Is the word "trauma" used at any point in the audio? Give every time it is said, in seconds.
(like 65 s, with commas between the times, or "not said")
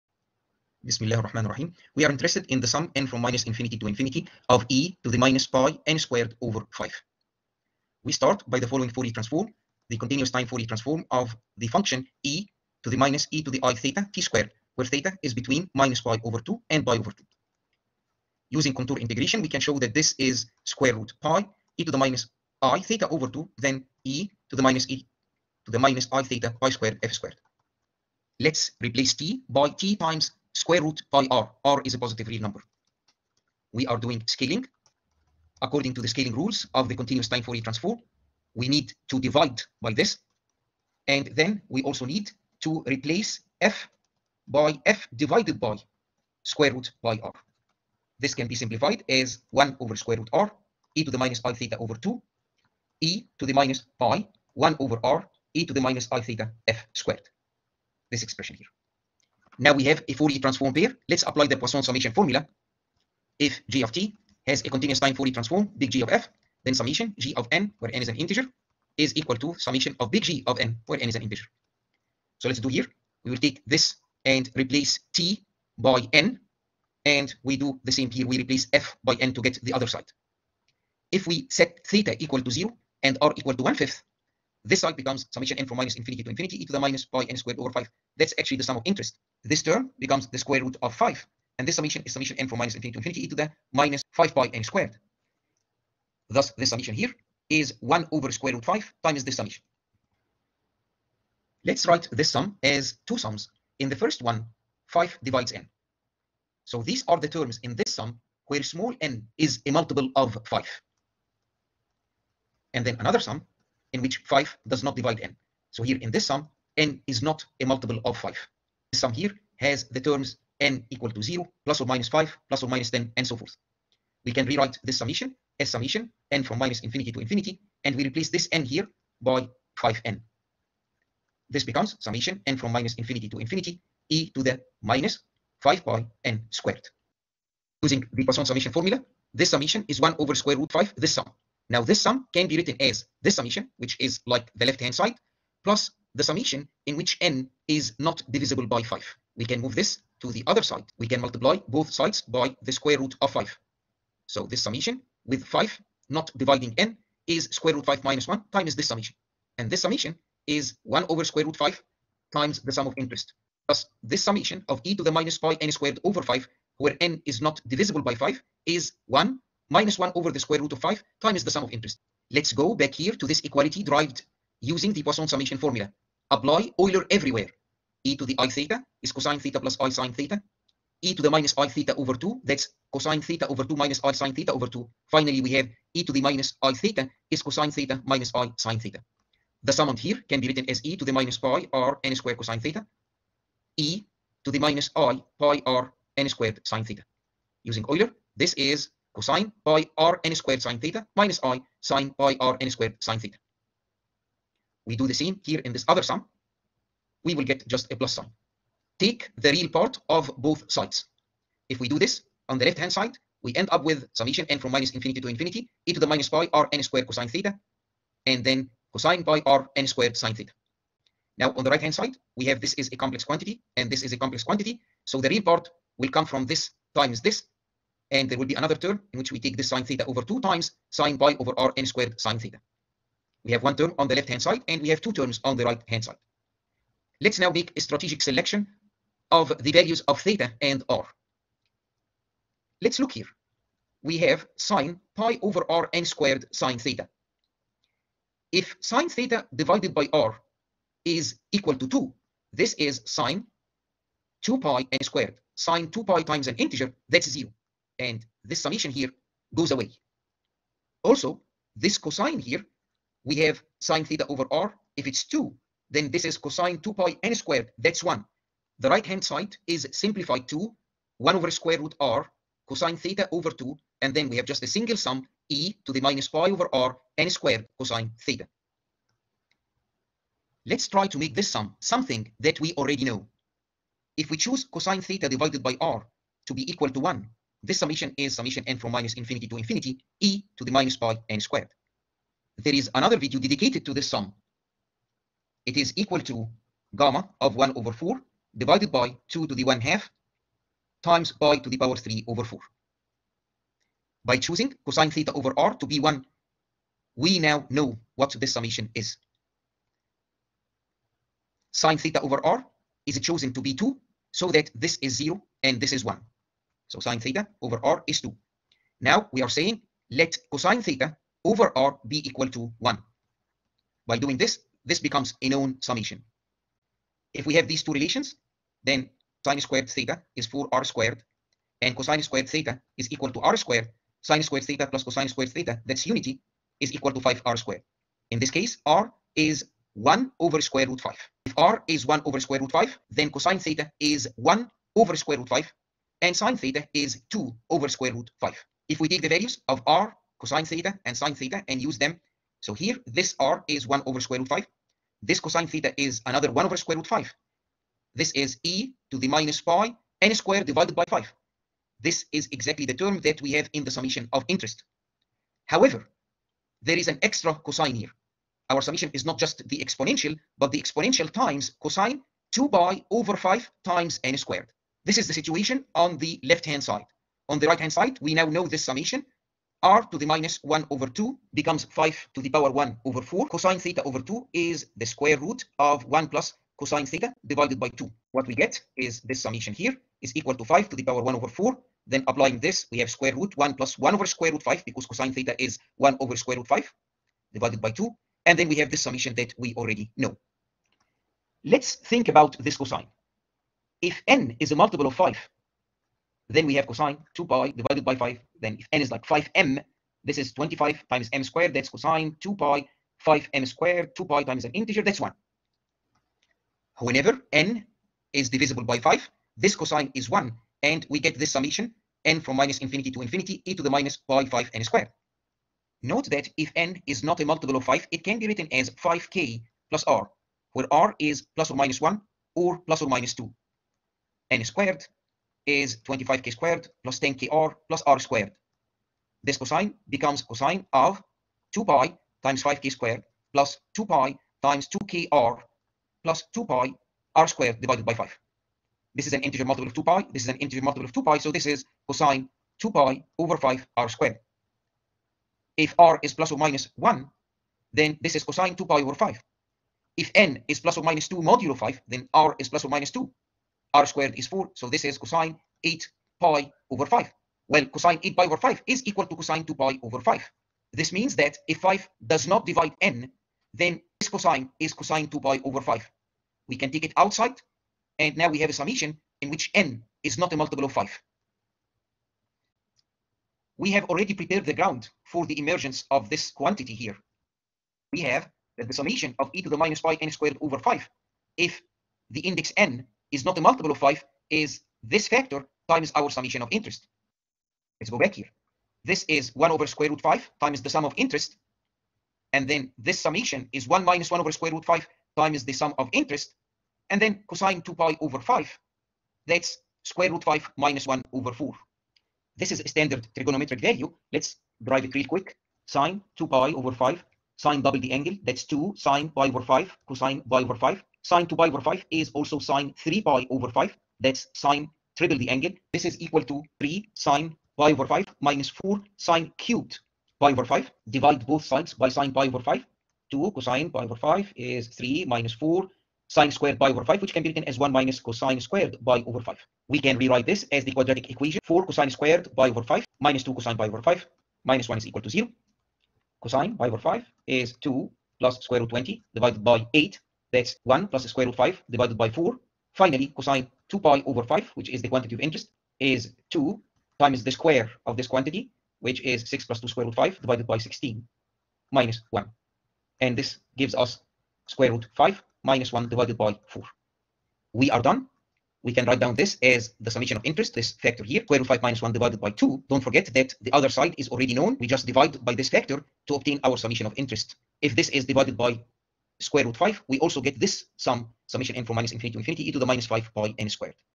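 not said.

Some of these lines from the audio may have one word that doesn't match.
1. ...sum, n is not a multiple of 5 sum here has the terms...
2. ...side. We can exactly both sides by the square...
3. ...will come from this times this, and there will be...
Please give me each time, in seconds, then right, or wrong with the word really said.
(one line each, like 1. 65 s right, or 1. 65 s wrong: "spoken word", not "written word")
1. 116 s right
2. 150 s wrong: "multiply", not "exactly"
3. 225 s right.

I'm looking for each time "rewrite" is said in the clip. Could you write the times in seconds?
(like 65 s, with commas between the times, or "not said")
124 s, 540 s.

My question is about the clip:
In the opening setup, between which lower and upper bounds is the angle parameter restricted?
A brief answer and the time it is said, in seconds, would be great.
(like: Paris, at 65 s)
-pi/2 to pi/2, at 15 s.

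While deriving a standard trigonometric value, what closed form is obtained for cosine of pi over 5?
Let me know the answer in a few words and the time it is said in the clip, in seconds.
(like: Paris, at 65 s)
(1+√5)/4, at 550 s.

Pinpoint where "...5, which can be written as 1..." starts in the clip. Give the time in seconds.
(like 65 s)
537 s.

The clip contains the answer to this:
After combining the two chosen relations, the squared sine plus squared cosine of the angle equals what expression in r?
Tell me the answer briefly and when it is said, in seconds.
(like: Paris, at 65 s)
5r squared, at 337 s.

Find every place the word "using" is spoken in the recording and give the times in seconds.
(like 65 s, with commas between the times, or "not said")
18 s, 137 s, 174 s, 197 s.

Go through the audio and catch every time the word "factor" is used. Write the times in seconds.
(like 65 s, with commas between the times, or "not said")
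495 s, 570 s, 575 s.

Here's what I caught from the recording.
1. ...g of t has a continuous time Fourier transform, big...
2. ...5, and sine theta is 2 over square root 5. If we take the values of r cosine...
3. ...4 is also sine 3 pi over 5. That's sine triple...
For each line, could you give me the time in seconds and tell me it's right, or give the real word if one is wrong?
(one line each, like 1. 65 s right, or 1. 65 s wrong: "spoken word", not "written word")
1. 63 s right
2. 345 s right
3. 521 s wrong: "5", not "4".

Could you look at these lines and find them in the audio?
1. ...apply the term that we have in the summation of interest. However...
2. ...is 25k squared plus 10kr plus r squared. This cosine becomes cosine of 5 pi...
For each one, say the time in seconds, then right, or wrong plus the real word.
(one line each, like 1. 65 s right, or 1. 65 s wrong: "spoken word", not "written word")
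1. 362 s wrong: "exactly", not "apply"
2. 435 s wrong: "2", not "5".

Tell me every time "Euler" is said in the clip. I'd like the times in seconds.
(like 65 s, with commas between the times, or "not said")
176 s, 197 s.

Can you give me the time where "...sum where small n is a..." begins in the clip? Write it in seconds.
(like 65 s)
107 s.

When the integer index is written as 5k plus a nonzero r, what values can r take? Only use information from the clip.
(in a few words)
±1 or ±2.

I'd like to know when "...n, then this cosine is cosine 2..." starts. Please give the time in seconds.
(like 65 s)
473 s.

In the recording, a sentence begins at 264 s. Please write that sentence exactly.
If it's 2, then this is cosine 2 pi n squared.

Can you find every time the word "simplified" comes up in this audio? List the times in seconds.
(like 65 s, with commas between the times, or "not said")
48 s, 269 s.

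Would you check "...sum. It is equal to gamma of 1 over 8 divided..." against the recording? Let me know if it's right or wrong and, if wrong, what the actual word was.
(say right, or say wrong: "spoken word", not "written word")
wrong: "4", not "8".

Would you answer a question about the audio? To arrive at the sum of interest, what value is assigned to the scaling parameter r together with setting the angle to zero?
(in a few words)
1/5.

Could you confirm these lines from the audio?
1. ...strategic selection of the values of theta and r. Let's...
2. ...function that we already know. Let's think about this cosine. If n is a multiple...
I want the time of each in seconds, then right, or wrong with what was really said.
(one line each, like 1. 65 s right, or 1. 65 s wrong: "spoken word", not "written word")
1. 237 s right
2. 399 s wrong: "summation", not "function".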